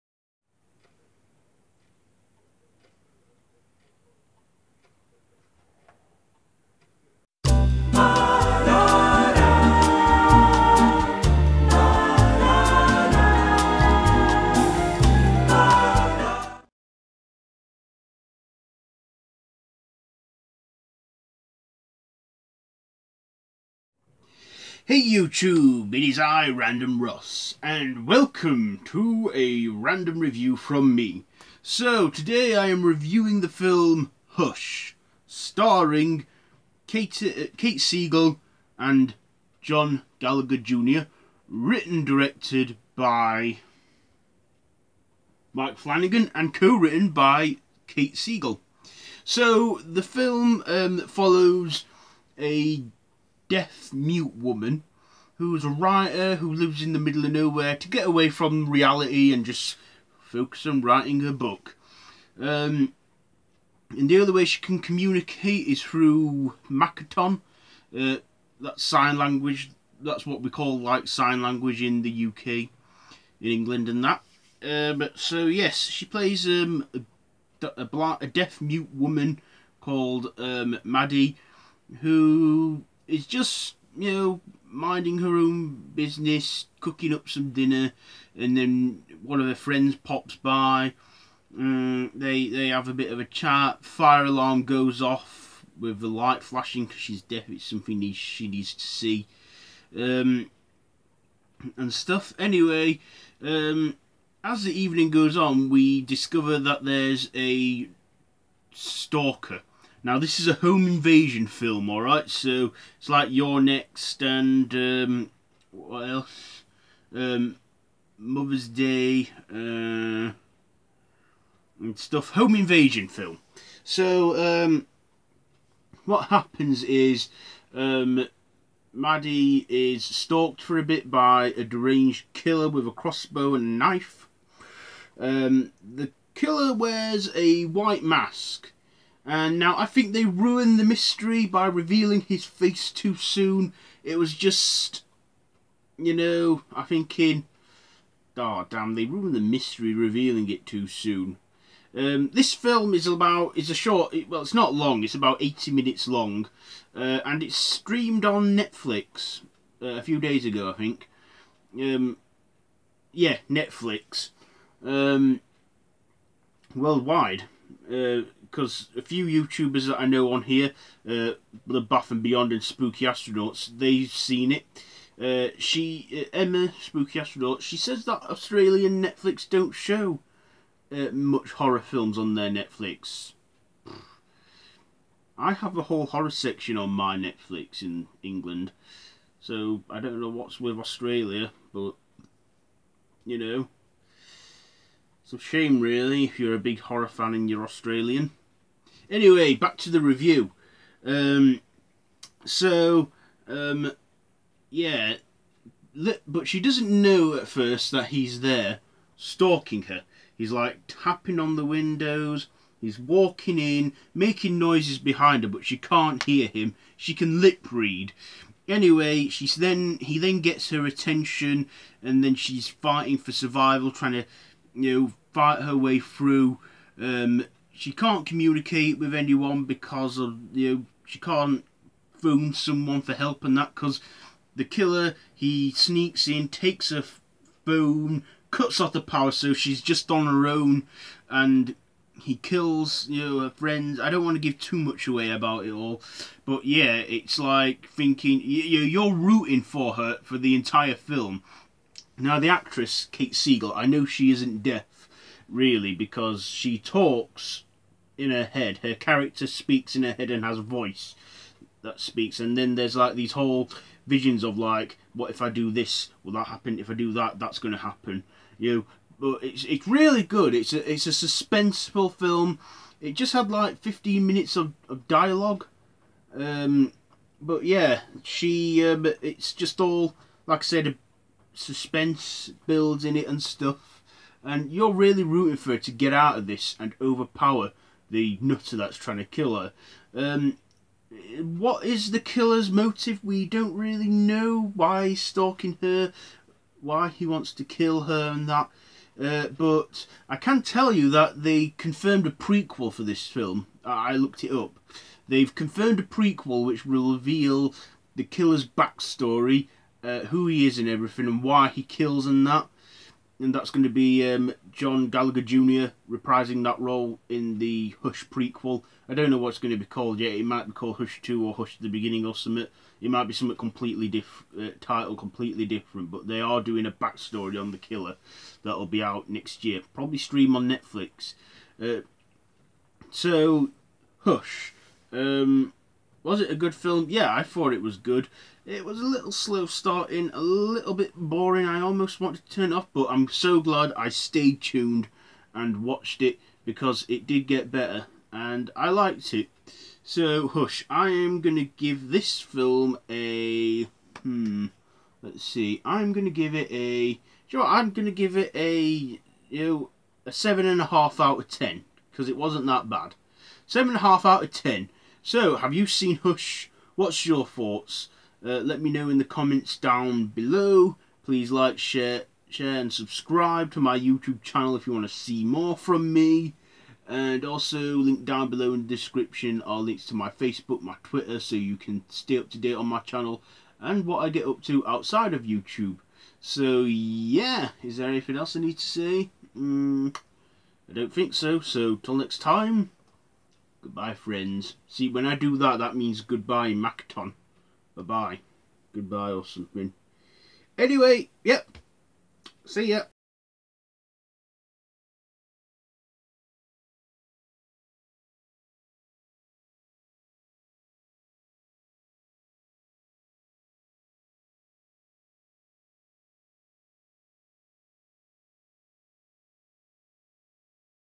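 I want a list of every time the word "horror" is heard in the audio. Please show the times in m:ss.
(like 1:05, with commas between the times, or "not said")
3:01, 3:06, 3:16.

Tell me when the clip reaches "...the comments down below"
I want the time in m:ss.
6:09.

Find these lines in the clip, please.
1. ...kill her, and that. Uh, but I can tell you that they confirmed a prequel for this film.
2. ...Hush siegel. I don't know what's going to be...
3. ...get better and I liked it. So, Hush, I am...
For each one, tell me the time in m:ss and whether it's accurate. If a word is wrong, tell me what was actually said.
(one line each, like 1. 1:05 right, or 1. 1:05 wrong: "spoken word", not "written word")
1. 4:57 right
2. 5:18 wrong: "prequel", not "siegel"
3. 5:47 right.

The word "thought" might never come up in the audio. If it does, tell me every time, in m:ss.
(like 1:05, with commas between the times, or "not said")
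5:37, 6:07.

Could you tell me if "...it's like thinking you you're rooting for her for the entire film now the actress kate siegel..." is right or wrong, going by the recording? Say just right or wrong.
right.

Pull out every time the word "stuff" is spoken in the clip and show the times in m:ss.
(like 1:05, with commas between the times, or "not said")
1:41, 2:01, 4:43.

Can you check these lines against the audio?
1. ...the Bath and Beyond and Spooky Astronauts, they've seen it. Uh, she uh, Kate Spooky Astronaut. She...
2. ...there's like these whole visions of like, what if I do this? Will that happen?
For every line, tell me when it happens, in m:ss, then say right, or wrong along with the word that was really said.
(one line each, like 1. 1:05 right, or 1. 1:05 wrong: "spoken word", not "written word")
1. 2:51 wrong: "Emma", not "Kate"
2. 4:22 right.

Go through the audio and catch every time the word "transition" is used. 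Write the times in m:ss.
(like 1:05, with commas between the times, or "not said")
not said.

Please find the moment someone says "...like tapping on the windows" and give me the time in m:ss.
3:30.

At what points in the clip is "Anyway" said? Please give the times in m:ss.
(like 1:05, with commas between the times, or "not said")
1:42, 3:19, 3:38, 6:40.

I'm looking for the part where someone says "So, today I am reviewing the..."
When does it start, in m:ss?
0:31.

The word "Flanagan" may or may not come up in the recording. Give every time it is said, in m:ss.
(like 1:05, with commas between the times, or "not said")
0:45.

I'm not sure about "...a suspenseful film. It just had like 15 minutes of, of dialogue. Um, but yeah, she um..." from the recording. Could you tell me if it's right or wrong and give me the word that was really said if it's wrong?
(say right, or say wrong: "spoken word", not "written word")
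right.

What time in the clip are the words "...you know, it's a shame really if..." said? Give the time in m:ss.
3:13.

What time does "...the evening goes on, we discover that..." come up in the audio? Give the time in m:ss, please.
1:44.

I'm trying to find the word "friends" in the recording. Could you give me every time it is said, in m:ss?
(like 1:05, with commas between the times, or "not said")
1:29, 4:03, 6:34.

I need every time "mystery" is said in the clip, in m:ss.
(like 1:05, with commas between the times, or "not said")
2:20, 2:29.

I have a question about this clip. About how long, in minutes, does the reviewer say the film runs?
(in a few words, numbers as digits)
80 minutes.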